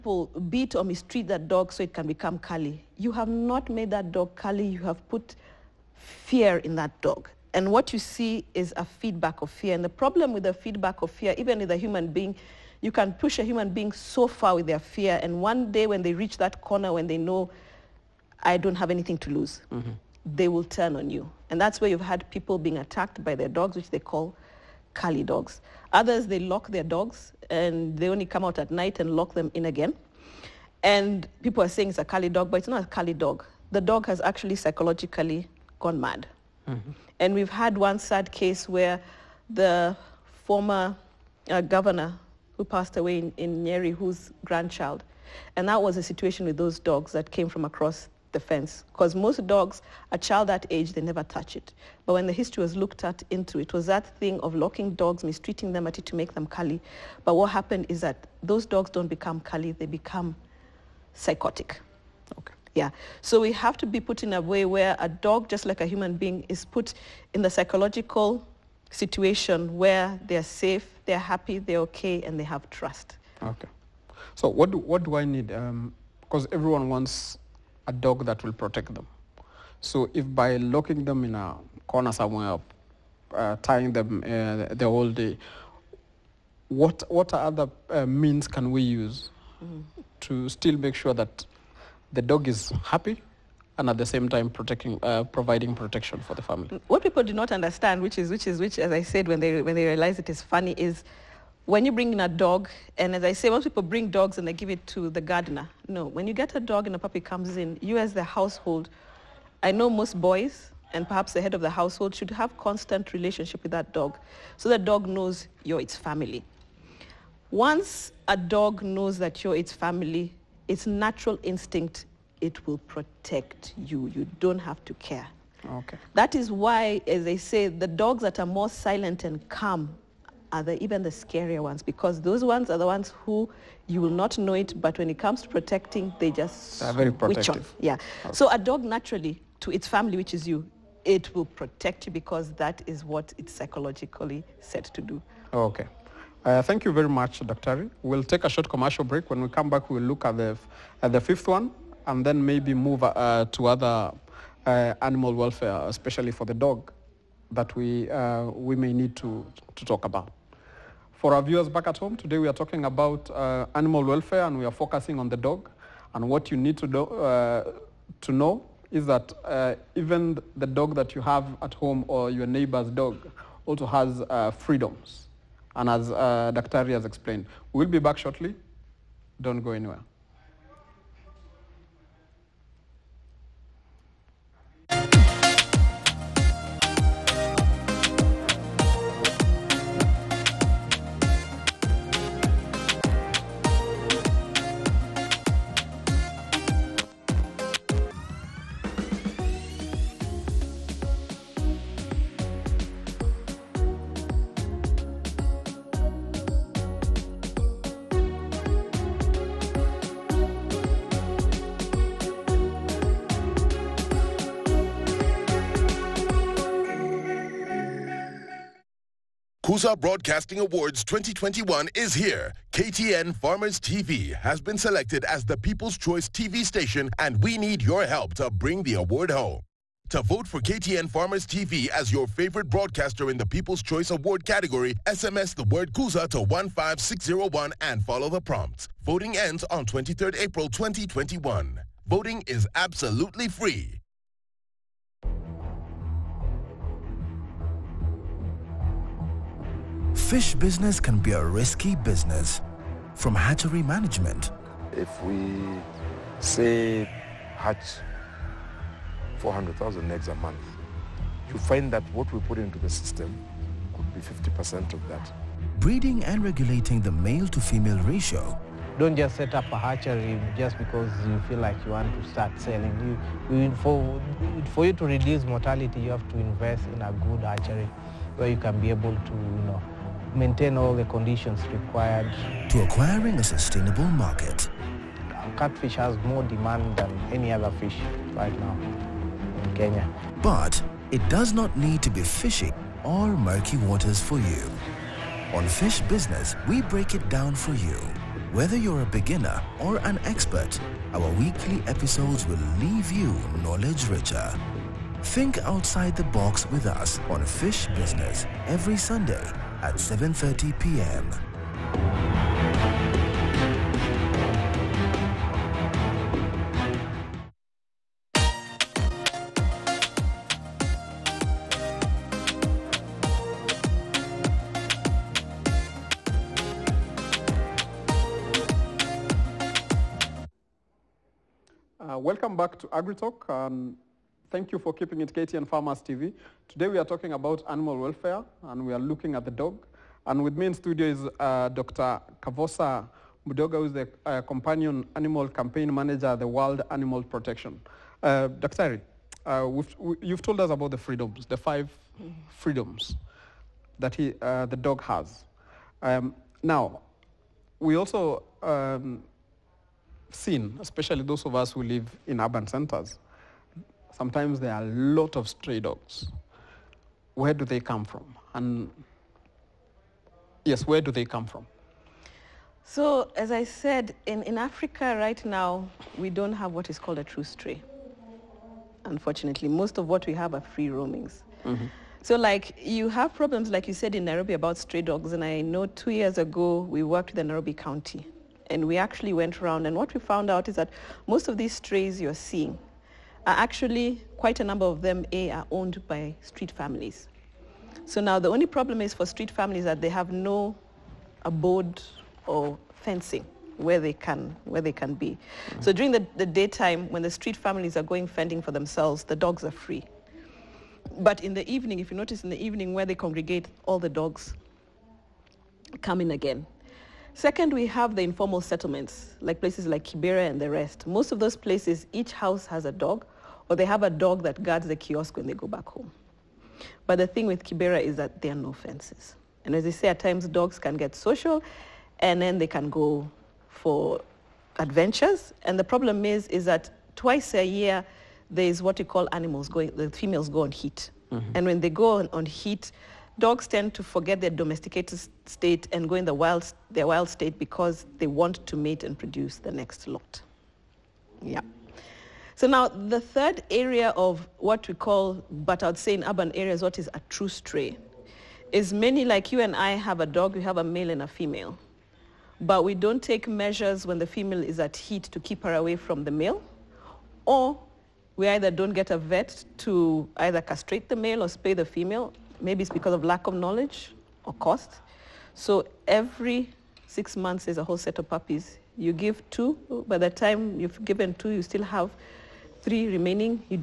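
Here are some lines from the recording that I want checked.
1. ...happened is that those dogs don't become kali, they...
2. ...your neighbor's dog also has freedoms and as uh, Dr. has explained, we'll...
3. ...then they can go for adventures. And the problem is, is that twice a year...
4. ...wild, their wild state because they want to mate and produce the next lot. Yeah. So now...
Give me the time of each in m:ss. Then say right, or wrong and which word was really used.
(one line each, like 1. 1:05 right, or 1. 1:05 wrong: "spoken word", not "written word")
1. 0:57 right
2. 2:52 right
3. 7:12 right
4. 7:26 right.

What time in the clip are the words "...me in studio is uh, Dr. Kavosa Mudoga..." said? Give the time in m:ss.
5:40.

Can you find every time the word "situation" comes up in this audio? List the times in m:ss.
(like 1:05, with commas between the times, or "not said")
0:46, 1:08.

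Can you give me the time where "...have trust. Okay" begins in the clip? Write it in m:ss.
1:12.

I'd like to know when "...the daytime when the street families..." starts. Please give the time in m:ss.
6:46.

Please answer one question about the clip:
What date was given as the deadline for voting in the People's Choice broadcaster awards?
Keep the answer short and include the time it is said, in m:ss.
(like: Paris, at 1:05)
23rd April 2021, at 3:59.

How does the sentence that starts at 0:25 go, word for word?
Others, they lock their dogs and they only come out at night and lock them in again.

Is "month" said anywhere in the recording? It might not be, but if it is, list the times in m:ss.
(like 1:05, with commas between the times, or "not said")
4:20, 7:57.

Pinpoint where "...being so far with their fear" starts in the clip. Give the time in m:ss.
0:13.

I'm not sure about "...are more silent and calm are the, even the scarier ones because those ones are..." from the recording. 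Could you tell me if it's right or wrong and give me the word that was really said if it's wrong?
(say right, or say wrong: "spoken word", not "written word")
right.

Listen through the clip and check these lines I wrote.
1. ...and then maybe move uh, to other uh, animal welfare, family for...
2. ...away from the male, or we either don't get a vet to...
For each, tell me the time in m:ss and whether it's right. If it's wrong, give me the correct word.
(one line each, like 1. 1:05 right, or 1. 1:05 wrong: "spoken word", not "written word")
1. 2:32 wrong: "especially", not "family"
2. 7:45 right.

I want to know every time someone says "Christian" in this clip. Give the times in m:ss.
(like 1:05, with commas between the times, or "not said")
not said.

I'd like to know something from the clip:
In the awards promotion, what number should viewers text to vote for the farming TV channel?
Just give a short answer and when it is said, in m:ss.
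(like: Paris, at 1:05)
15601, at 3:56.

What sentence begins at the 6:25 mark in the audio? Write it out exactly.
And I know two years ago, we worked with the Nairobi County.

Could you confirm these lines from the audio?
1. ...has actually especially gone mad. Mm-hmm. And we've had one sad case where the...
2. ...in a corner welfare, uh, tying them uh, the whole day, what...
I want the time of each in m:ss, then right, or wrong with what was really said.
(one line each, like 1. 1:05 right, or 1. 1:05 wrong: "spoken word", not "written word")
1. 0:34 wrong: "psychologically", not "especially"
2. 1:21 wrong: "somewhere", not "welfare".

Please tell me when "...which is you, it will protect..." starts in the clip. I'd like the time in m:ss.
2:20.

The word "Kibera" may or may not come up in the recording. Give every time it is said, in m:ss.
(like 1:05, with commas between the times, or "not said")
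7:00, 7:07.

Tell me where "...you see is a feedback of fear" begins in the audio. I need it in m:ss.
0:07.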